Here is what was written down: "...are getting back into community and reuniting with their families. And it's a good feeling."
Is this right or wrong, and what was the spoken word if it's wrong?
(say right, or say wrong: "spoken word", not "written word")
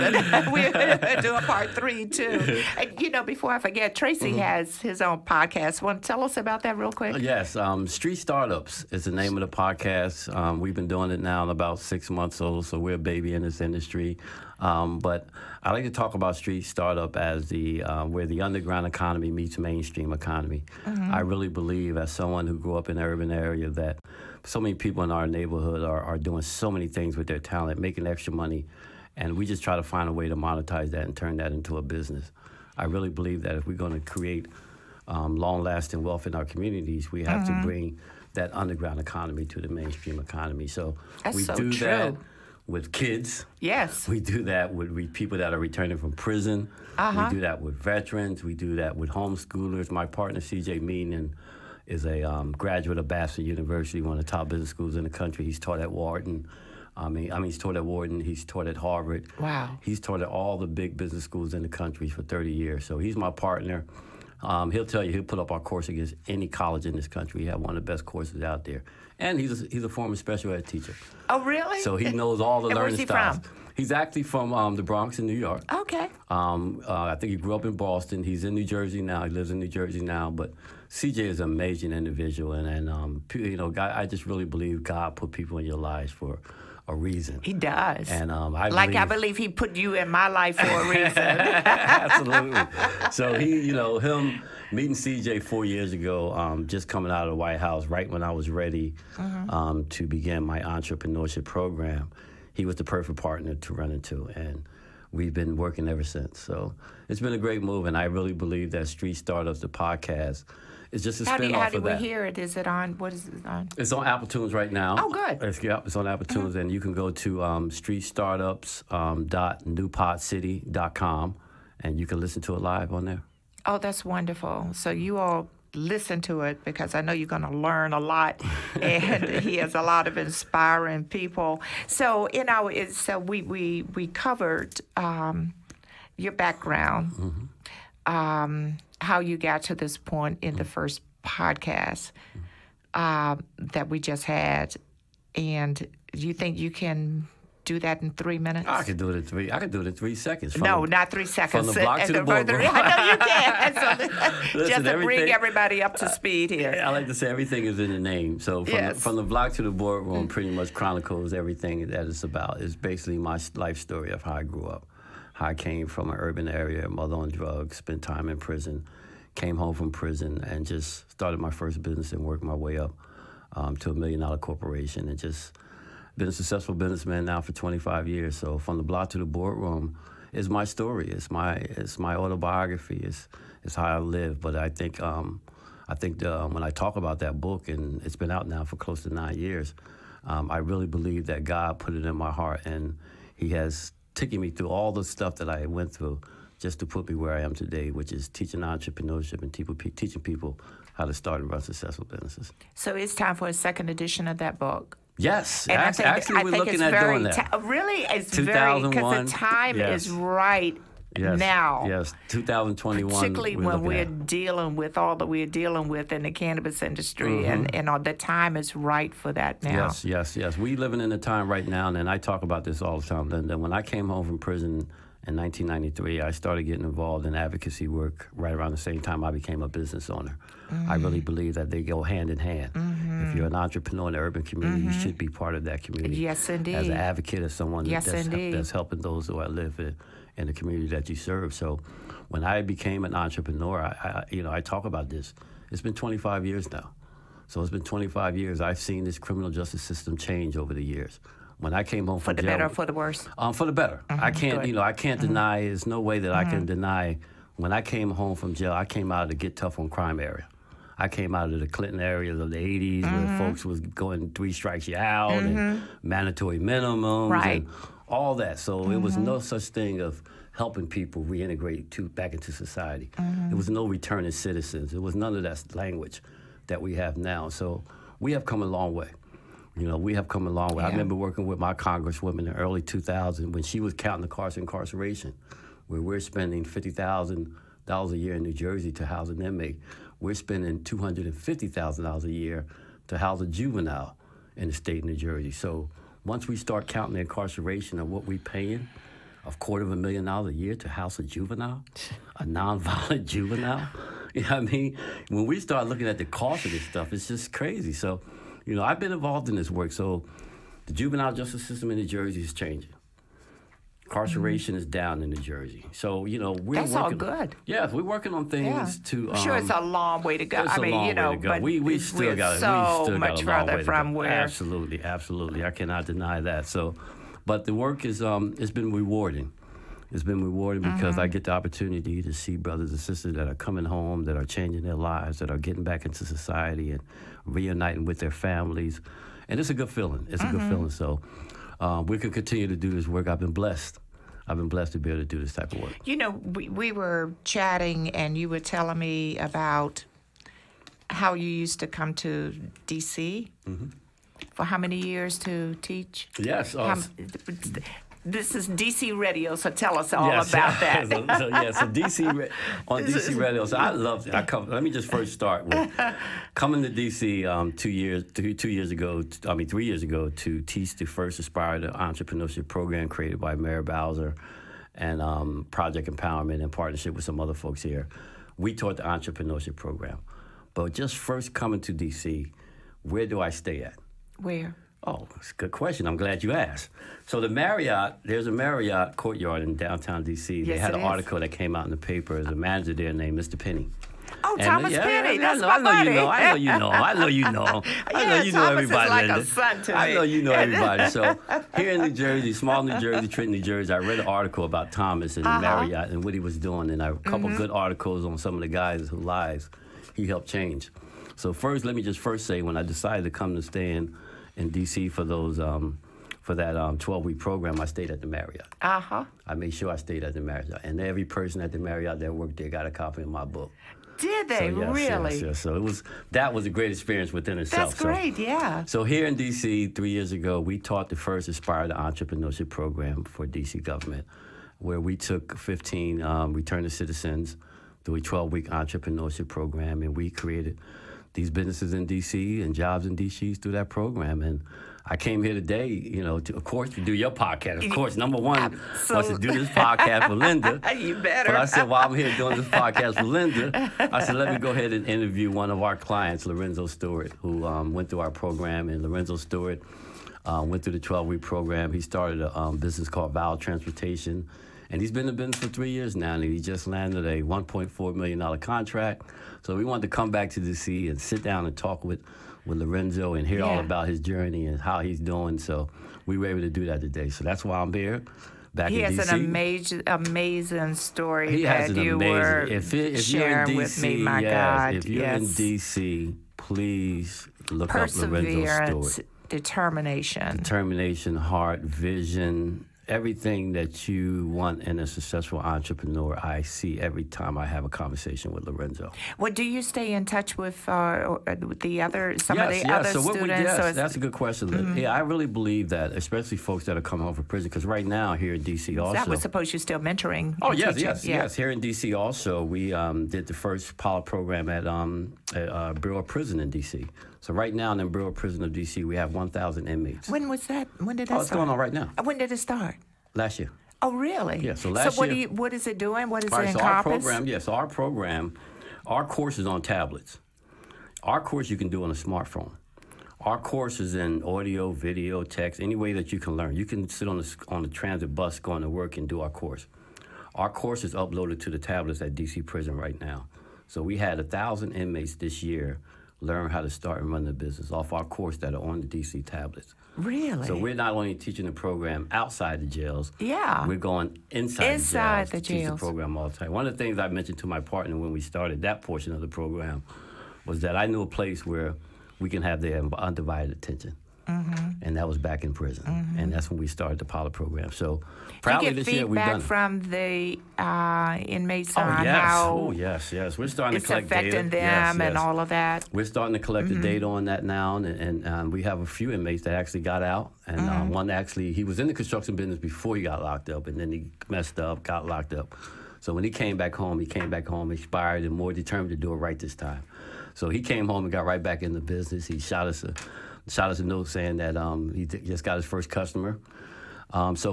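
wrong: "society", not "community".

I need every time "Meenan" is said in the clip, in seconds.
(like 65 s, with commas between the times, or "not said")
50 s.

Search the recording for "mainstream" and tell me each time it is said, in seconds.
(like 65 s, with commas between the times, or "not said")
19 s, 39 s.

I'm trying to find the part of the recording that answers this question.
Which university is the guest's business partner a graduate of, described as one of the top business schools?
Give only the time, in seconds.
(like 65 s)
53 s.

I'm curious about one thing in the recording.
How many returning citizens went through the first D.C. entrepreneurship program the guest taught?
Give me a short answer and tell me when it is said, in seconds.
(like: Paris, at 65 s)
15, at 435 s.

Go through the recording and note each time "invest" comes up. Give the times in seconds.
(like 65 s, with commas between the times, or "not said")
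not said.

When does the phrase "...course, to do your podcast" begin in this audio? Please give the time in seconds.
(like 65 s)
446 s.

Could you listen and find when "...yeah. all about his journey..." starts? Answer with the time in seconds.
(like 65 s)
473 s.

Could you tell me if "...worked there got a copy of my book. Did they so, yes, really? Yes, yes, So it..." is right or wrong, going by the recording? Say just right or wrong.
right.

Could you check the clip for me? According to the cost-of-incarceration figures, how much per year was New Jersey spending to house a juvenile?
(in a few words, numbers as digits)
$250,000.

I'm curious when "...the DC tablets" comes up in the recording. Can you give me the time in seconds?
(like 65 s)
549 s.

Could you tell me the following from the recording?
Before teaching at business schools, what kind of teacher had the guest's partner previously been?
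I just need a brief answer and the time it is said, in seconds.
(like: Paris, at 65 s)
special ed teacher, at 70 s.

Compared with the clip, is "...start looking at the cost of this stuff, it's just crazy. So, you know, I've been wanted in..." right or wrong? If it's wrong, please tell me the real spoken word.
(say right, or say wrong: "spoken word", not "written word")
wrong: "involved", not "wanted".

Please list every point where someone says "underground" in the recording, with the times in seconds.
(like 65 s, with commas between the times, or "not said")
18 s, 38 s.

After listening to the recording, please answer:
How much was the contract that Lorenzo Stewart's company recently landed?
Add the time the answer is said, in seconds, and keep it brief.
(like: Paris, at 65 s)
$1.4 million, at 467 s.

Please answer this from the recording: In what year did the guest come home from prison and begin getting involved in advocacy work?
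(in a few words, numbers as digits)
1993.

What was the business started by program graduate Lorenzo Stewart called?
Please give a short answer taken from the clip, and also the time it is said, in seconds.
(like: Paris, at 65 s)
Val Transportation, at 463 s.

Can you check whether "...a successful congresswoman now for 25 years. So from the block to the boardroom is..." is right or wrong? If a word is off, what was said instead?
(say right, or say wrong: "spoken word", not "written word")
wrong: "businessman", not "congresswoman".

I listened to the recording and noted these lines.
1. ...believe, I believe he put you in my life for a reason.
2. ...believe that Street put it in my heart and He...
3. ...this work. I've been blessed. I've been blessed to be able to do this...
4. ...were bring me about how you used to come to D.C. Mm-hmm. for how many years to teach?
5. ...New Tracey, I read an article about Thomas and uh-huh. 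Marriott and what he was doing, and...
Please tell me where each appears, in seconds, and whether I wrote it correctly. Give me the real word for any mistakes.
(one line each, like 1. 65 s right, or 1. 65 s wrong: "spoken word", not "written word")
1. 88 s right
2. 190 s wrong: "God", not "Street"
3. 342 s right
4. 348 s wrong: "telling", not "bring"
5. 403 s wrong: "Jersey", not "Tracey".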